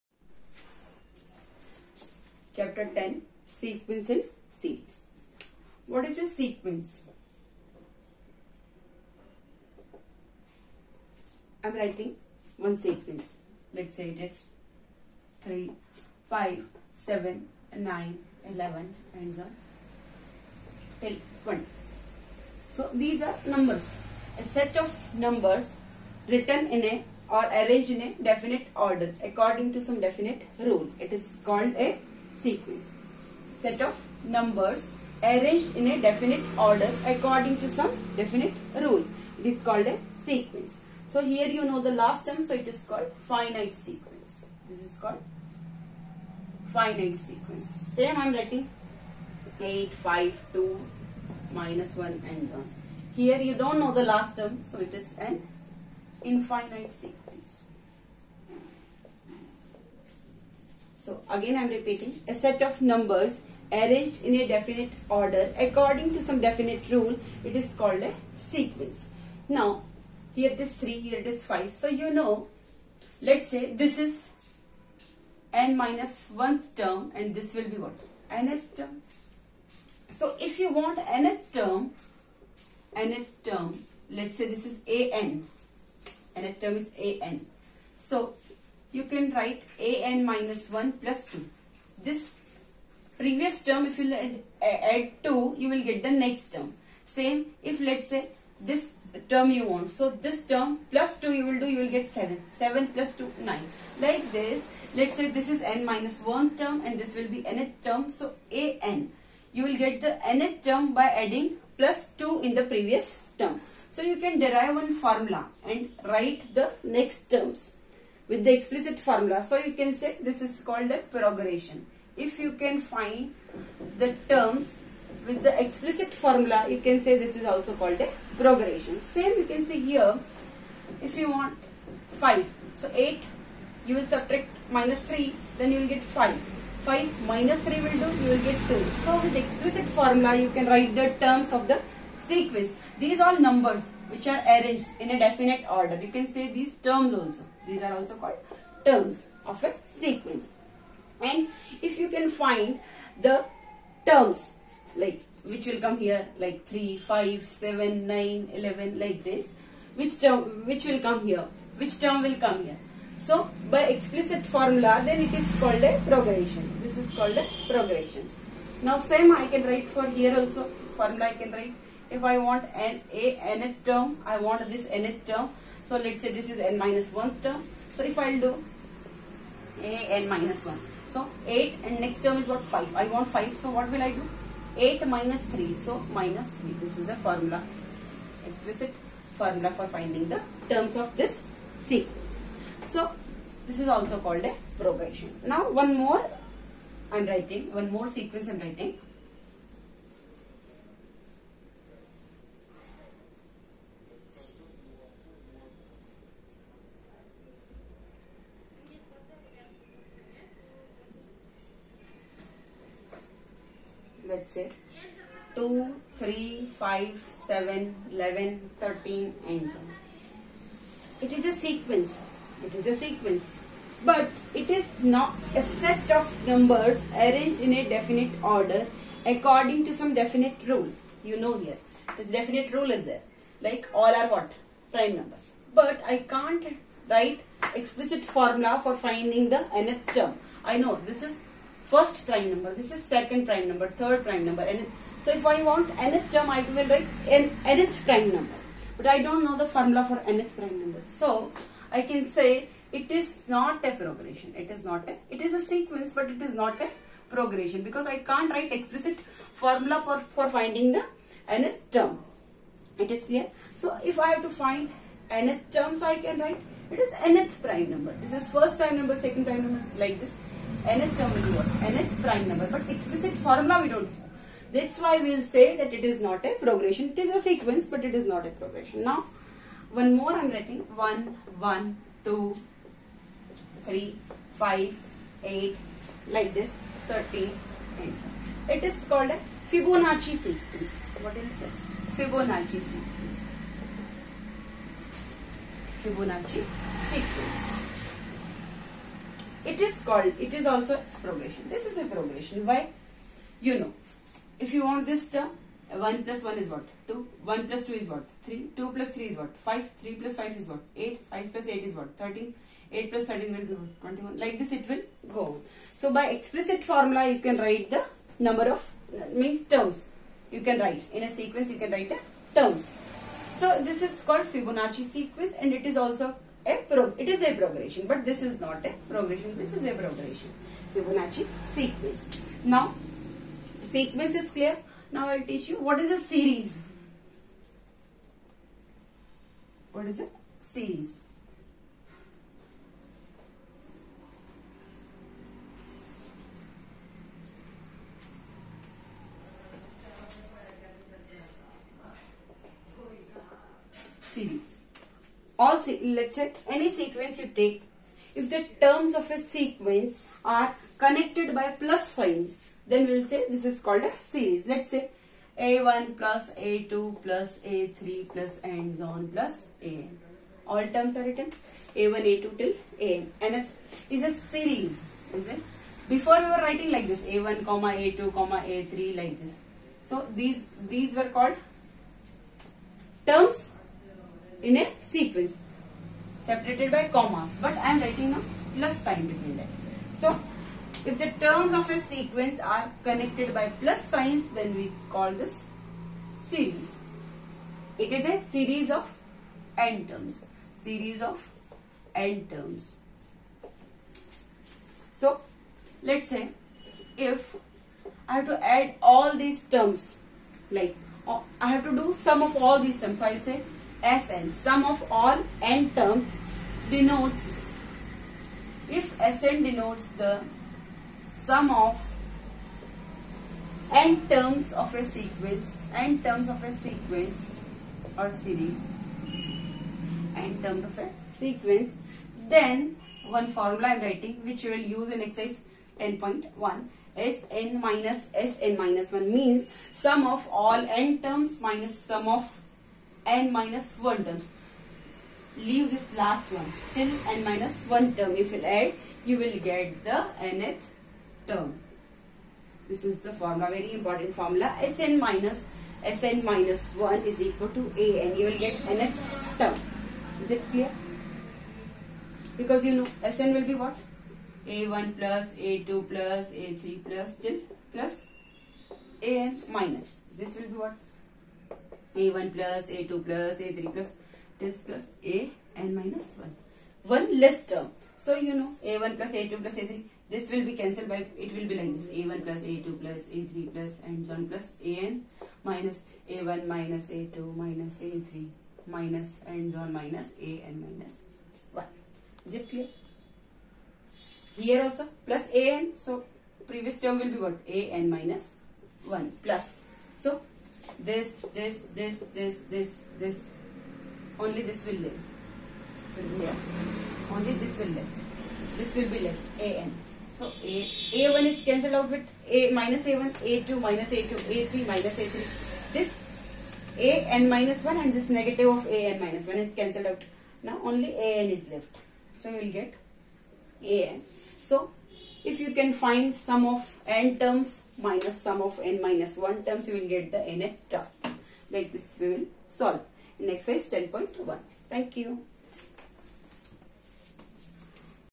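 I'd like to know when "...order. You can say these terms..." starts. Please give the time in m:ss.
2:25.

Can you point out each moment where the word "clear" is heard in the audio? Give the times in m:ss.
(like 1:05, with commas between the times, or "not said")
4:23, 5:34, 7:40, 8:12.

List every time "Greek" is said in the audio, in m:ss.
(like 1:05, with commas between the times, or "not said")
not said.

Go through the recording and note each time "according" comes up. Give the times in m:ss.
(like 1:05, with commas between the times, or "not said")
0:29, 0:37, 1:05, 3:49.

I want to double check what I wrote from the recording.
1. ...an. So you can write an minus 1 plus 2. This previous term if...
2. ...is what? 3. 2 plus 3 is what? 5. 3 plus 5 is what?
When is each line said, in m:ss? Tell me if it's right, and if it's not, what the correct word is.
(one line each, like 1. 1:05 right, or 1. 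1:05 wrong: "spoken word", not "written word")
1. 1:27 right
2. 5:07 right.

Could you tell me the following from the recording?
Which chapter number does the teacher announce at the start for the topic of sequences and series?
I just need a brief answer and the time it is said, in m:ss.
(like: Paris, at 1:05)
10, at 0:02.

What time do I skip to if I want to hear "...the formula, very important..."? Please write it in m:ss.
7:33.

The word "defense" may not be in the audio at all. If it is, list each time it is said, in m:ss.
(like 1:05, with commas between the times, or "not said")
not said.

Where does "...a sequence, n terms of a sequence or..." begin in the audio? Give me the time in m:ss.
7:04.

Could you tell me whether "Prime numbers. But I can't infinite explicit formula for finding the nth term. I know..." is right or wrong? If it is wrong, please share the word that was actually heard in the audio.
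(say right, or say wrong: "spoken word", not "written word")
wrong: "write", not "infinite".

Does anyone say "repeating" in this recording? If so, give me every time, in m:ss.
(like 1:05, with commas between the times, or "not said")
1:01.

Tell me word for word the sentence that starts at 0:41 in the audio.
So here you know the last term so it is called finite sequence.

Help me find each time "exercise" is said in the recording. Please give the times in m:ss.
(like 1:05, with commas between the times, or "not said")
7:15, 8:53.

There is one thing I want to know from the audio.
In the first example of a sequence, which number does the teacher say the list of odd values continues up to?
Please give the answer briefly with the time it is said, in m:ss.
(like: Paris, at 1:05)
20, at 0:21.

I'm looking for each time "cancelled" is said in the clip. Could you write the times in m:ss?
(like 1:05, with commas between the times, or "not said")
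8:00, 8:31, 8:39.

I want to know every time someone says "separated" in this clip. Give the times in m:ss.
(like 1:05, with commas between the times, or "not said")
6:26.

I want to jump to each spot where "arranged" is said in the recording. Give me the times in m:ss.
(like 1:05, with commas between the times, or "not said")
0:27, 0:35, 1:03, 2:24, 3:47.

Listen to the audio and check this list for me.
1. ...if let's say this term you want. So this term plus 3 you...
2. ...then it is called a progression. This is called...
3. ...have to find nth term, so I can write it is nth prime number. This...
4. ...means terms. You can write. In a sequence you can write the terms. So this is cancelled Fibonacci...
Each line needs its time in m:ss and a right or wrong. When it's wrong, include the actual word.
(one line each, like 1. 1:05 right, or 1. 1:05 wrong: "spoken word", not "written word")
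1. 1:37 wrong: "2", not "3"
2. 2:45 right
3. 4:24 right
4. 5:19 wrong: "called", not "cancelled".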